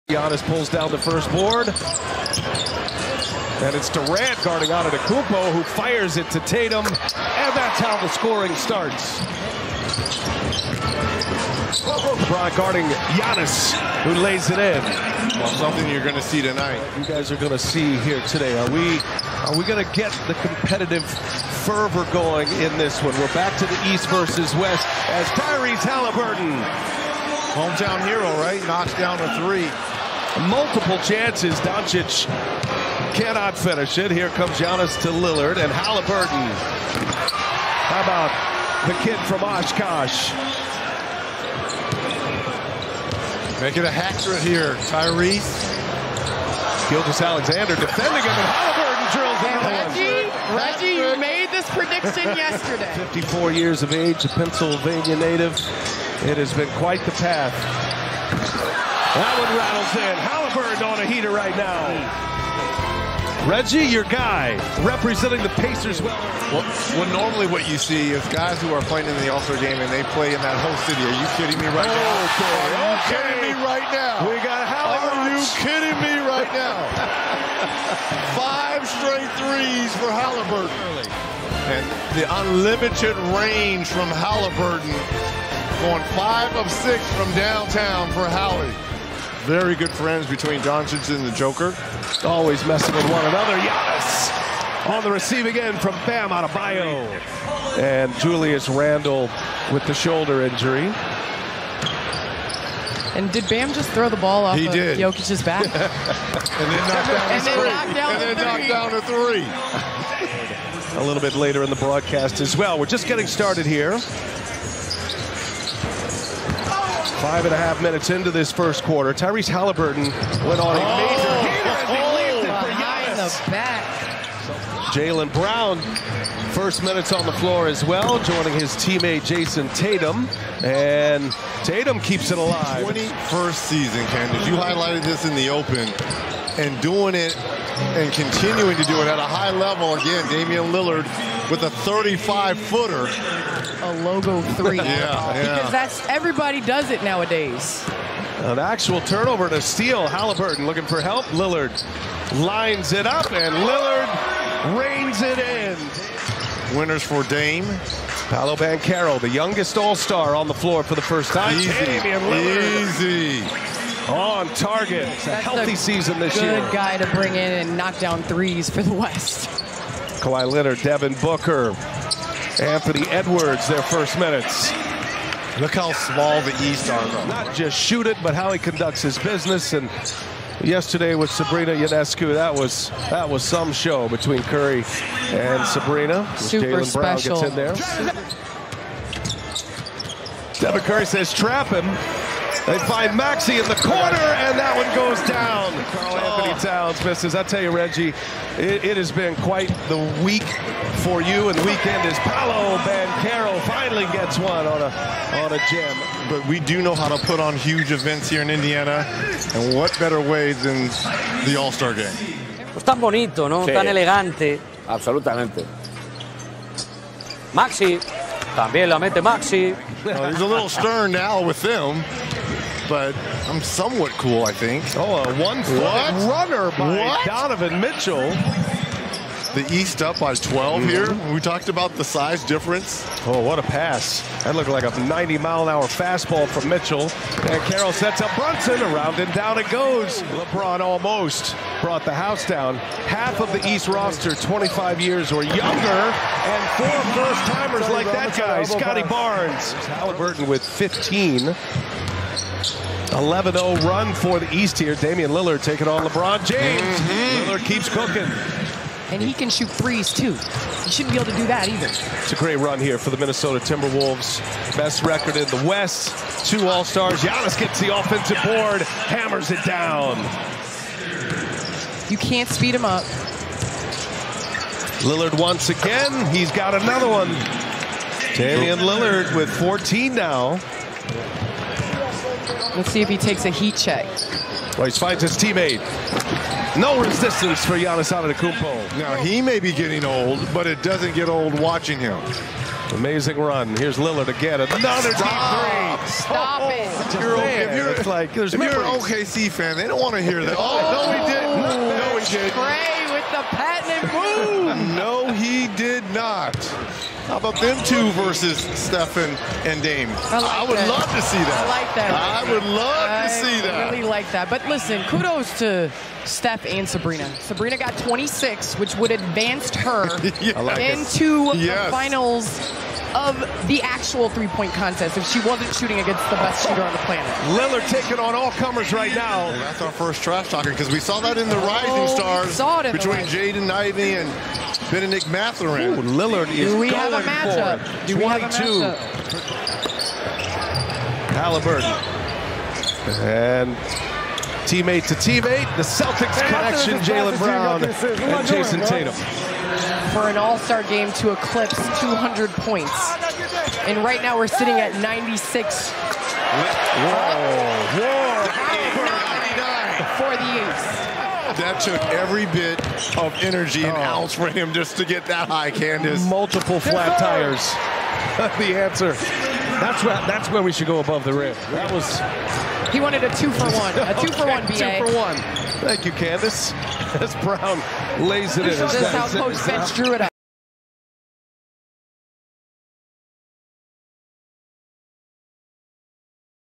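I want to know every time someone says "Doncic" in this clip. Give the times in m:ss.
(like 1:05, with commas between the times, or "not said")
0:31, 1:30.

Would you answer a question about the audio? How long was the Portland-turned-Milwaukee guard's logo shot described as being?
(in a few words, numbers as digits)
35 feet.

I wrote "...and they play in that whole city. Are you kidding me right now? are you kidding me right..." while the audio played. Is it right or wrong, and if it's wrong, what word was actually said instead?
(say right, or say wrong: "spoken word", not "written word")
right.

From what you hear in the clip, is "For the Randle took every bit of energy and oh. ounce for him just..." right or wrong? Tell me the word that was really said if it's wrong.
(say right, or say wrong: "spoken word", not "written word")
wrong: "That", not "Randle".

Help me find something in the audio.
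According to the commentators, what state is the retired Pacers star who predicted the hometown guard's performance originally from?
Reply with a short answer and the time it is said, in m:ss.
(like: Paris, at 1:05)
Pennsylvania, at 0:54.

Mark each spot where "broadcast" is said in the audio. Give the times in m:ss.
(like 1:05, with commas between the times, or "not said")
1:51.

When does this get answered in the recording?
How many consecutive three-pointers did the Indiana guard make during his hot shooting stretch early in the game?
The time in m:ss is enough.
1:18.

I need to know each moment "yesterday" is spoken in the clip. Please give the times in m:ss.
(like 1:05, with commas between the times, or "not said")
0:52, 3:00.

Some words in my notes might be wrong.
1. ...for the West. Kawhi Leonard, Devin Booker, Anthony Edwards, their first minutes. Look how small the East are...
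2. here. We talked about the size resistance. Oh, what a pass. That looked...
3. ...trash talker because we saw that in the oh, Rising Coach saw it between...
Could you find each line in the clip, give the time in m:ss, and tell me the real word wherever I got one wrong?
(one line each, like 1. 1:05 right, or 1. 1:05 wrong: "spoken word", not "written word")
1. 2:48 right
2. 3:50 wrong: "difference", not "resistance"
3. 5:30 wrong: "Stars", not "Coach".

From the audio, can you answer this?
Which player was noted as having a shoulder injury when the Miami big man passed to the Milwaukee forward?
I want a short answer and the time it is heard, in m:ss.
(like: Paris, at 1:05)
Julius Randle, at 1:38.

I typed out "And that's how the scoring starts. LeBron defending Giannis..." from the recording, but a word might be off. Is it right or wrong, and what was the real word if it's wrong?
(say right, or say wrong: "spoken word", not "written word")
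wrong: "guarding", not "defending".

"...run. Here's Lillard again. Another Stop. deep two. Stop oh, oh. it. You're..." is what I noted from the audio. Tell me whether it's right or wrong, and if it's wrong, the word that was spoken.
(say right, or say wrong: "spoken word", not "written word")
wrong: "three", not "two".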